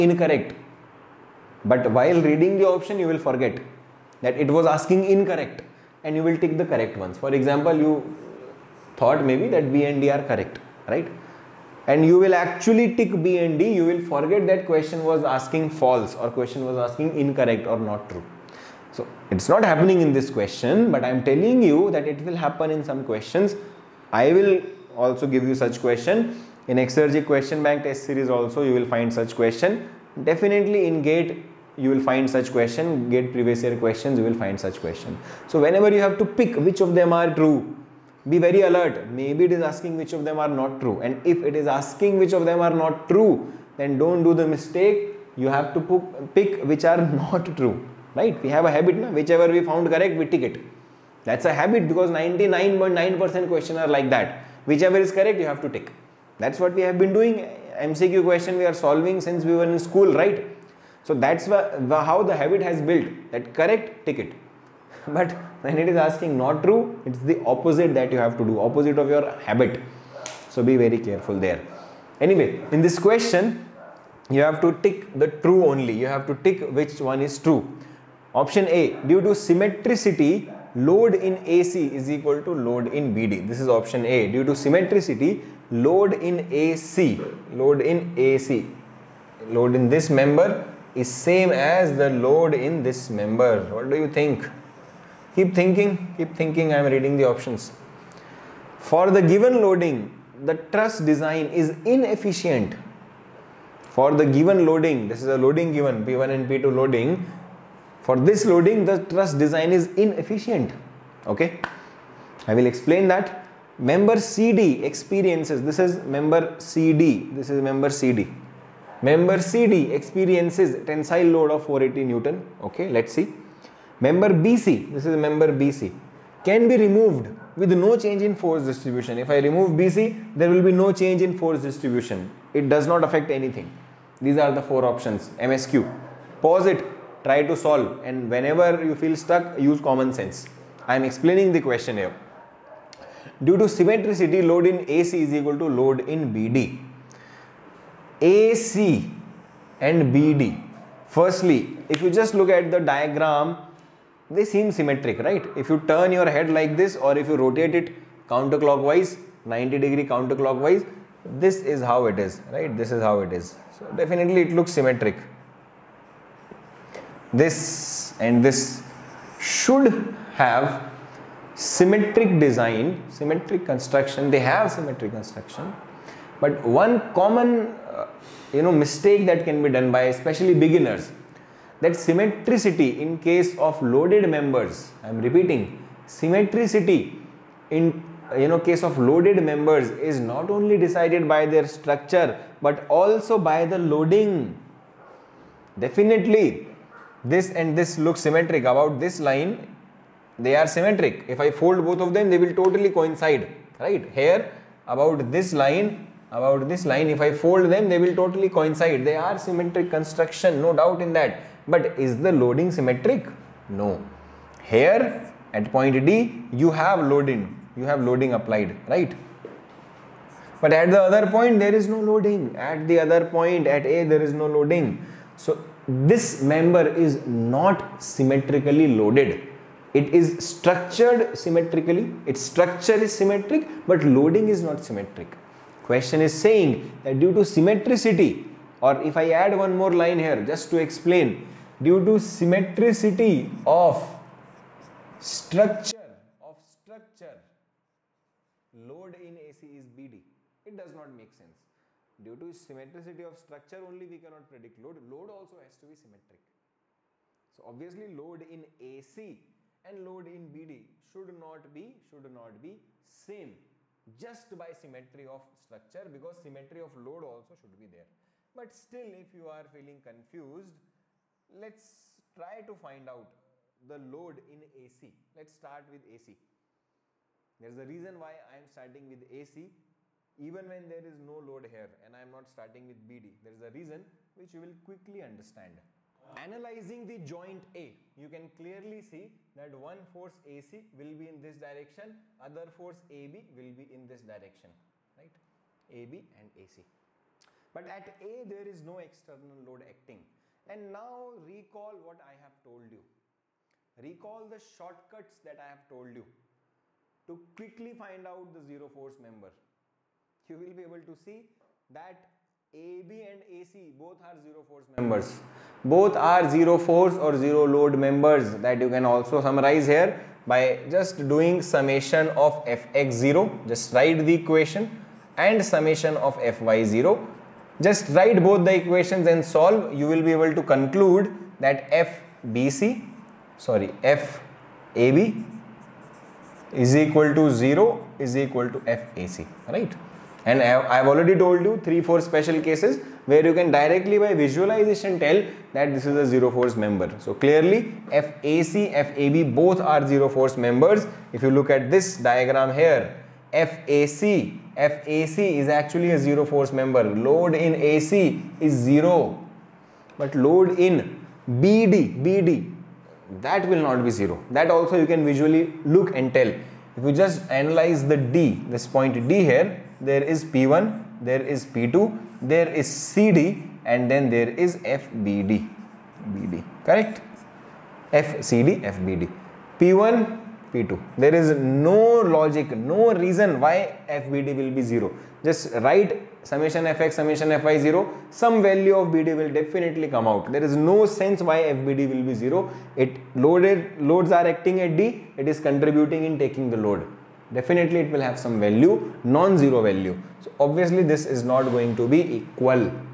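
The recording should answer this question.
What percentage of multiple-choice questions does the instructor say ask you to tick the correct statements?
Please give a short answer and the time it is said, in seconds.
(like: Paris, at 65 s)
99.9%, at 52 s.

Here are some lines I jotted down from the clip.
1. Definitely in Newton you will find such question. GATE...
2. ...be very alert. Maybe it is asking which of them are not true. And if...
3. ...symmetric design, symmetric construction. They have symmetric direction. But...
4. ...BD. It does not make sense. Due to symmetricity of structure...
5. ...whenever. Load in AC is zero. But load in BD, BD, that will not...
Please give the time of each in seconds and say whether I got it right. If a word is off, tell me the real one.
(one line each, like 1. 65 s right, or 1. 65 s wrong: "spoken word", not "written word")
1. 30 s wrong: "GATE", not "Newton"
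2. 38 s right
3. 171 s wrong: "construction", not "direction"
4. 249 s right
5. 356 s wrong: "member", not "whenever".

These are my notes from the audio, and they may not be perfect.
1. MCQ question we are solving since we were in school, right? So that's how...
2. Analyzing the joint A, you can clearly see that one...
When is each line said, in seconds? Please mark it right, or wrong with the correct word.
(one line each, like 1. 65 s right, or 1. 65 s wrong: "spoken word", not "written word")
1. 57 s right
2. 286 s right.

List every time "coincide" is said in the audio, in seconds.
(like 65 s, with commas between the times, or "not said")
202 s, 208 s.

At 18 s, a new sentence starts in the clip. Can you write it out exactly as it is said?
So it's not happening in this question, but I'm telling you that it will happen in some questions.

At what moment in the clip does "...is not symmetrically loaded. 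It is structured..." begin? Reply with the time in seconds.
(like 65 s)
226 s.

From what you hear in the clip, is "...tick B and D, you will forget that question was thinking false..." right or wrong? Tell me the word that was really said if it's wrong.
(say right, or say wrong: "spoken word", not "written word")
wrong: "asking", not "thinking".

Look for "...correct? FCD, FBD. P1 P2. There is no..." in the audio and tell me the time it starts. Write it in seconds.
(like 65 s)
376 s.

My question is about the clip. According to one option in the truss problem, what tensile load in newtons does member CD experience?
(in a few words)
480 newtons.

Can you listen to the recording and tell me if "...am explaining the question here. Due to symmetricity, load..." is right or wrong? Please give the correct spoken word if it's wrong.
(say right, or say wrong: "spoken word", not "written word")
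right.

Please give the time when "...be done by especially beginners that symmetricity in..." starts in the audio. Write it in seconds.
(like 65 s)
179 s.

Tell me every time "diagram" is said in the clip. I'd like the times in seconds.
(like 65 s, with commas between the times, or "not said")
152 s, 352 s.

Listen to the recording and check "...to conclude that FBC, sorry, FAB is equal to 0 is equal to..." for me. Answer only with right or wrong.
right.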